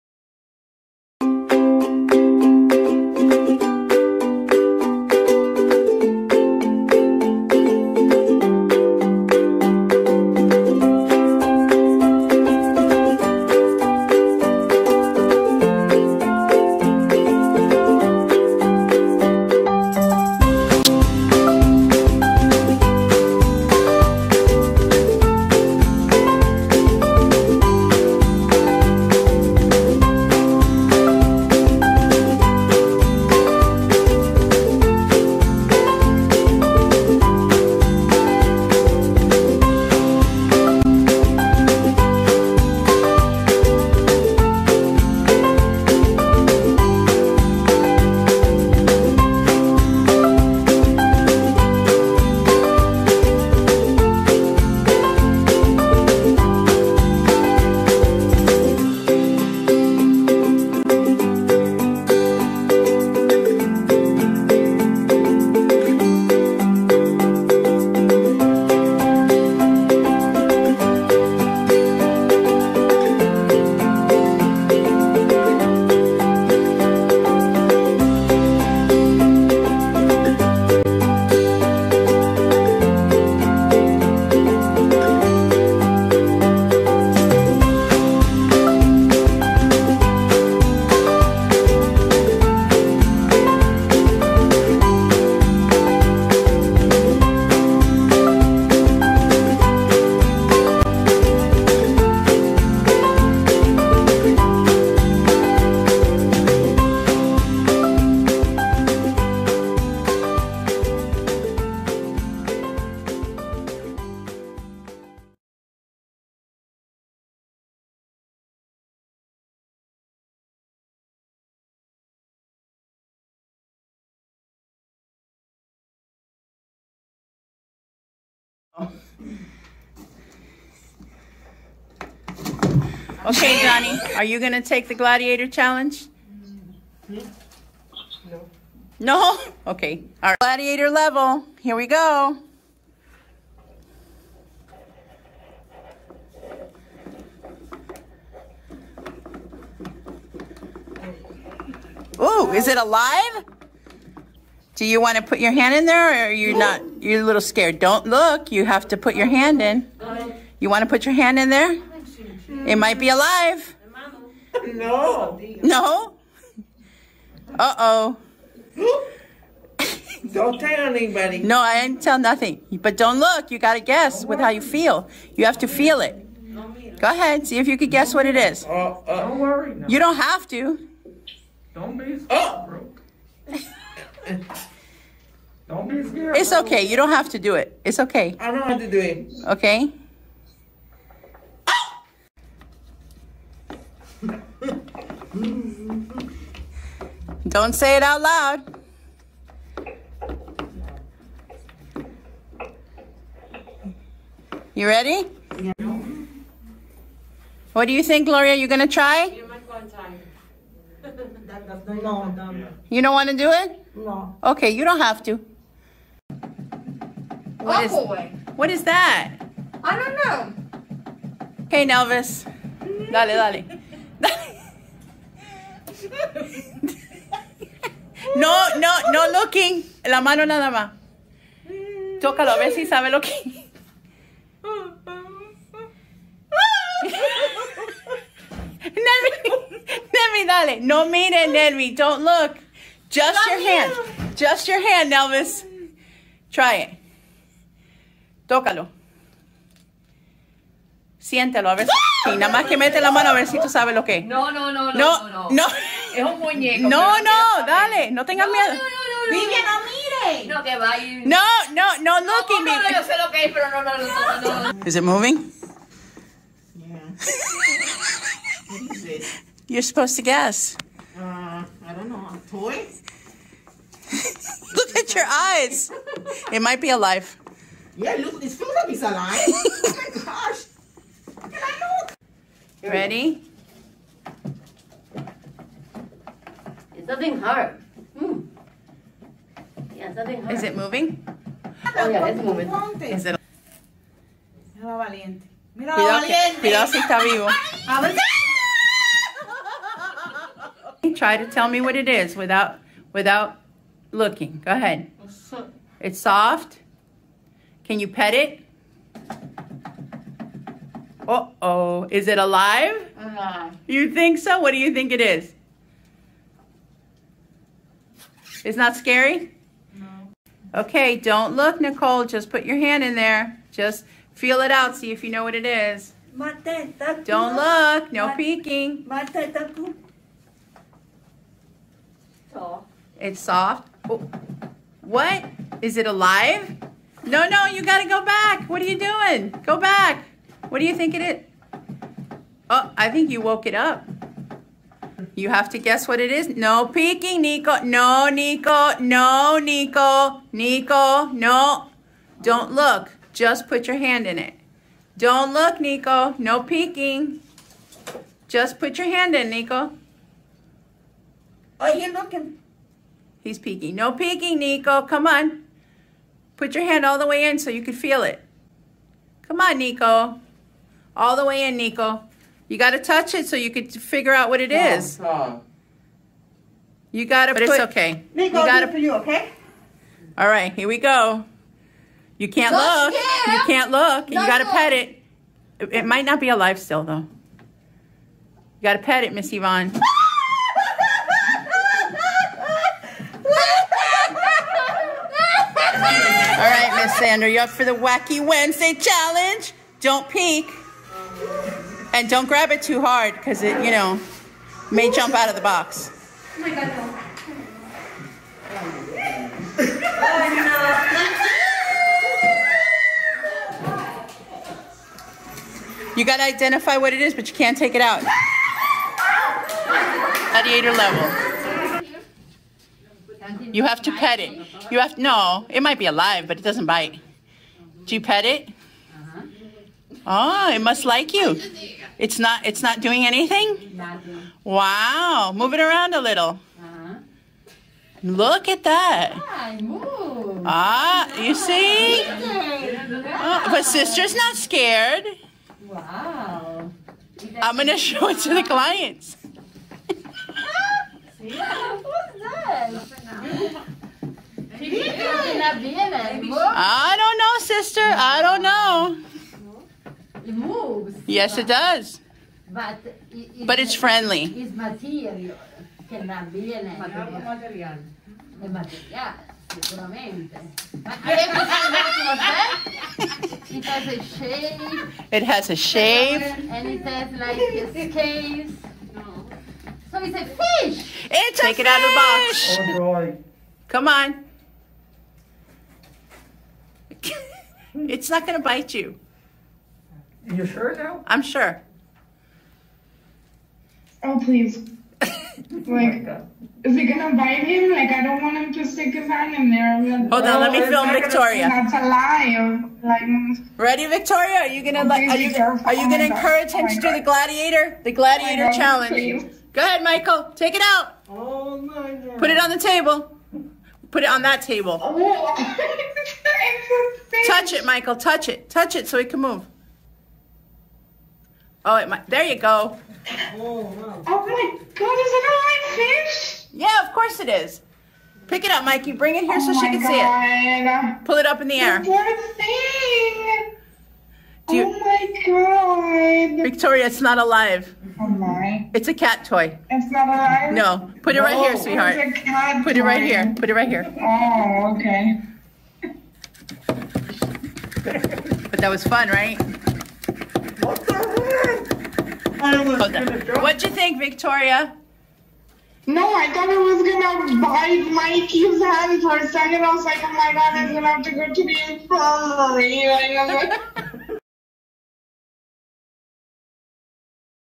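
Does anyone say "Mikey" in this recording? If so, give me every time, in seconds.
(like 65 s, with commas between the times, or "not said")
528 s, 558 s.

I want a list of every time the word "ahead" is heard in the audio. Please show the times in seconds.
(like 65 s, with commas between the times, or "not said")
177 s, 304 s, 509 s.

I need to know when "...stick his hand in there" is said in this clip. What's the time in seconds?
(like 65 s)
498 s.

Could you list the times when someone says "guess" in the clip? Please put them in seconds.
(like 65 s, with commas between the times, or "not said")
173 s, 177 s, 270 s, 345 s.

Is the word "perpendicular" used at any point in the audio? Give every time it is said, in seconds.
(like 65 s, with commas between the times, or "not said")
not said.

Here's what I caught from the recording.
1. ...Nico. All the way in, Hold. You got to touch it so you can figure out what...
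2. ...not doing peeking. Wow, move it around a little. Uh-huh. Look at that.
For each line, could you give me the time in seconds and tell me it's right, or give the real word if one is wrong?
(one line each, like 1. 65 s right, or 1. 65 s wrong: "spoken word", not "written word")
1. 369 s wrong: "Nico", not "Hold"
2. 432 s wrong: "anything", not "peeking".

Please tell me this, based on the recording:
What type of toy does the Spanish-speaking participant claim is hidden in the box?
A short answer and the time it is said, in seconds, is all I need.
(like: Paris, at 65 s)
Un muñeco, at 256 s.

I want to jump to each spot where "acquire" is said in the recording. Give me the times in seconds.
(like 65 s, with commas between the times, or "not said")
not said.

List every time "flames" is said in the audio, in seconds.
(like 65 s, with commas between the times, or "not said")
not said.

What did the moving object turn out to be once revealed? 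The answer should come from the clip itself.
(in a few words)
A cat toy.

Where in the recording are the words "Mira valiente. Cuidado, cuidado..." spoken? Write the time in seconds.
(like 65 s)
295 s.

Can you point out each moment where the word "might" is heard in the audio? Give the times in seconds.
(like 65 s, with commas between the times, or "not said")
162 s, 276 s, 386 s, 425 s, 522 s.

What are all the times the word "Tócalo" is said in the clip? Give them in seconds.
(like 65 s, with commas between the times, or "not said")
232 s, 248 s.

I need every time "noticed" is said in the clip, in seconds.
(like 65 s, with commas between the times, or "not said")
not said.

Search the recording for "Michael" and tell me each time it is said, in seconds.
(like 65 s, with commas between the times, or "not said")
510 s, 517 s.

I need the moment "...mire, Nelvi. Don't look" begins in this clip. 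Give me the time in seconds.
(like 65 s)
241 s.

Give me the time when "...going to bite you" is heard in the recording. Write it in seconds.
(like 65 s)
488 s.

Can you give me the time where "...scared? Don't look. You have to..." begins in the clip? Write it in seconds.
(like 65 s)
157 s.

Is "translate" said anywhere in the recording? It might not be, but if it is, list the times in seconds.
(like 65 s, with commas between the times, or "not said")
not said.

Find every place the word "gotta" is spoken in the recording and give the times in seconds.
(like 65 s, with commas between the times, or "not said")
378 s.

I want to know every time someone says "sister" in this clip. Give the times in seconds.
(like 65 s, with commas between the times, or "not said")
443 s, 457 s.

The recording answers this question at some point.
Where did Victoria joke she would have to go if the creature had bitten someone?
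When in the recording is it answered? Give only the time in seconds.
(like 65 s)
561 s.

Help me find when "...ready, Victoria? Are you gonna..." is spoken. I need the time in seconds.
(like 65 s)
503 s.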